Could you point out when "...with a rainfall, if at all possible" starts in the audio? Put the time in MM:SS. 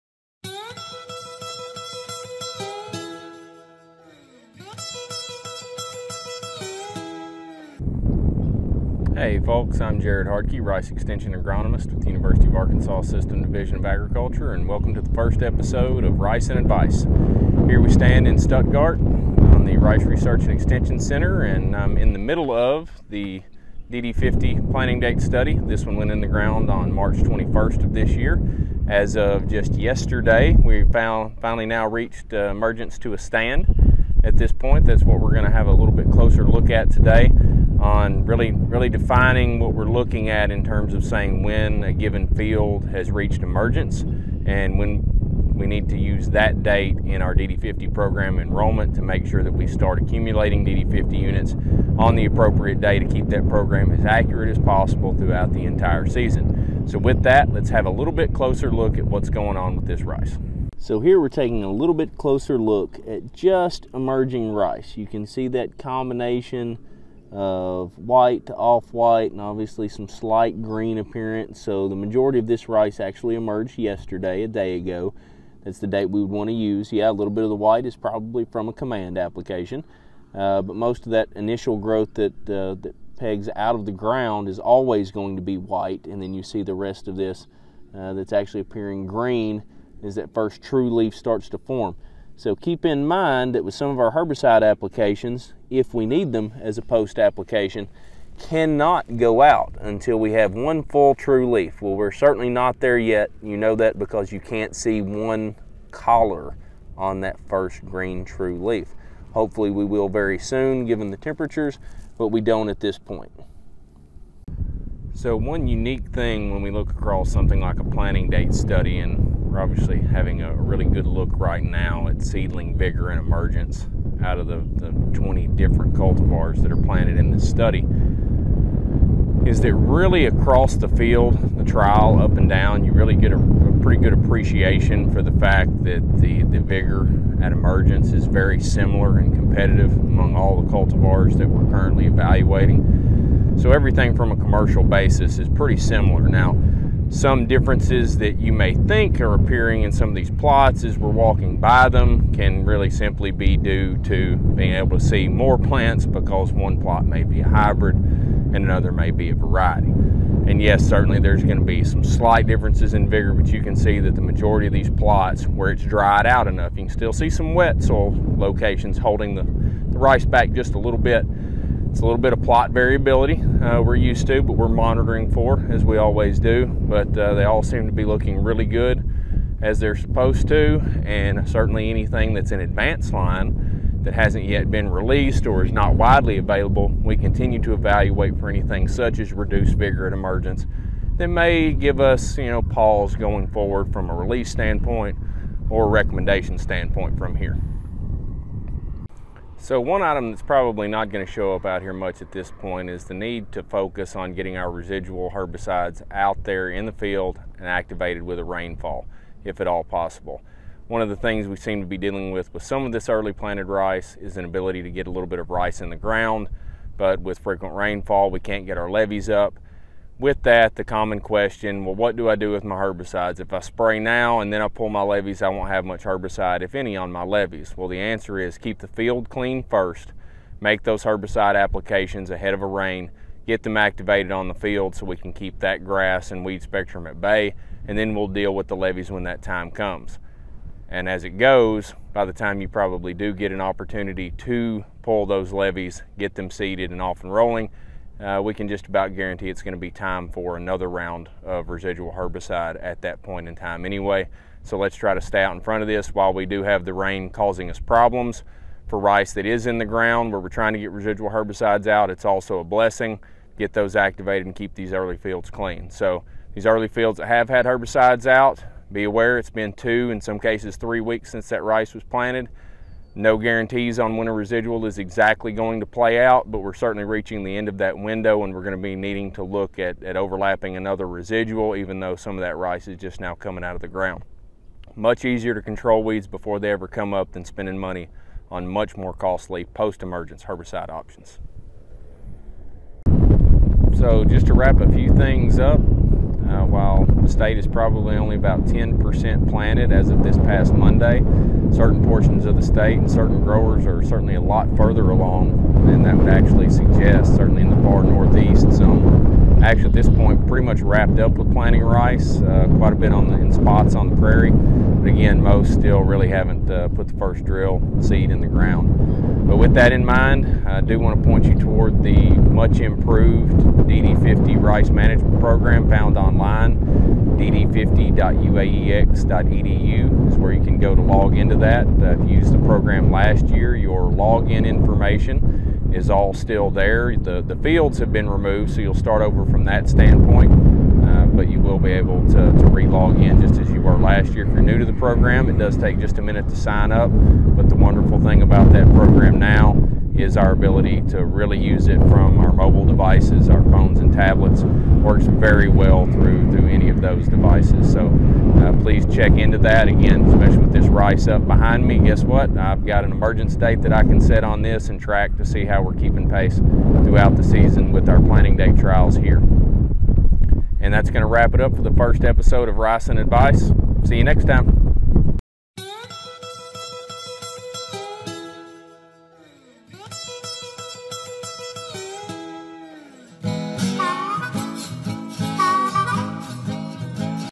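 03:28.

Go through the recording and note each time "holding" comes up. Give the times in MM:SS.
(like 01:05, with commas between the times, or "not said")
02:48.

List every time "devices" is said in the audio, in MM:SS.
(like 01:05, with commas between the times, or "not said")
05:52, 05:57.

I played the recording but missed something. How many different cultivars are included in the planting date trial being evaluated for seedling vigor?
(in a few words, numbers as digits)
20.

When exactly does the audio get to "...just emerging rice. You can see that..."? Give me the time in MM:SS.
01:03.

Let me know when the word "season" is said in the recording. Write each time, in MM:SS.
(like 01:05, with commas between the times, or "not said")
00:56, 06:07.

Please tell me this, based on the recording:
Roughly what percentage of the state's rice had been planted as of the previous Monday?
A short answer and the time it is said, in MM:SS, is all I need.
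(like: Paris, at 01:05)
10%, at 04:58.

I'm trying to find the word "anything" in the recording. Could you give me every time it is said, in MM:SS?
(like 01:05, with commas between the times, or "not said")
03:01, 03:08.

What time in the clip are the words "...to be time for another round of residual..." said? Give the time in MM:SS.
04:09.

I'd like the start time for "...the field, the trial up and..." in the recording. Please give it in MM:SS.
02:10.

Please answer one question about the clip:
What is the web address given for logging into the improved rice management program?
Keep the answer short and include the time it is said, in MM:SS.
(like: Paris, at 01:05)
DD50.uaex.edu, at 05:27.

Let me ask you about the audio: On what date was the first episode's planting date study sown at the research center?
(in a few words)
March 21.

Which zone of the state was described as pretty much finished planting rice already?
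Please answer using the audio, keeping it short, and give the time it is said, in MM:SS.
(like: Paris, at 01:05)
far northeast, at 05:07.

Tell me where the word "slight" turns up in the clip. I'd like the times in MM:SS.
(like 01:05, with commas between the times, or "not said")
01:10, 02:42.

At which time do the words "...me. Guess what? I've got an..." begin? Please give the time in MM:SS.
06:01.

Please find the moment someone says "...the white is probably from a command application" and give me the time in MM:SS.
01:17.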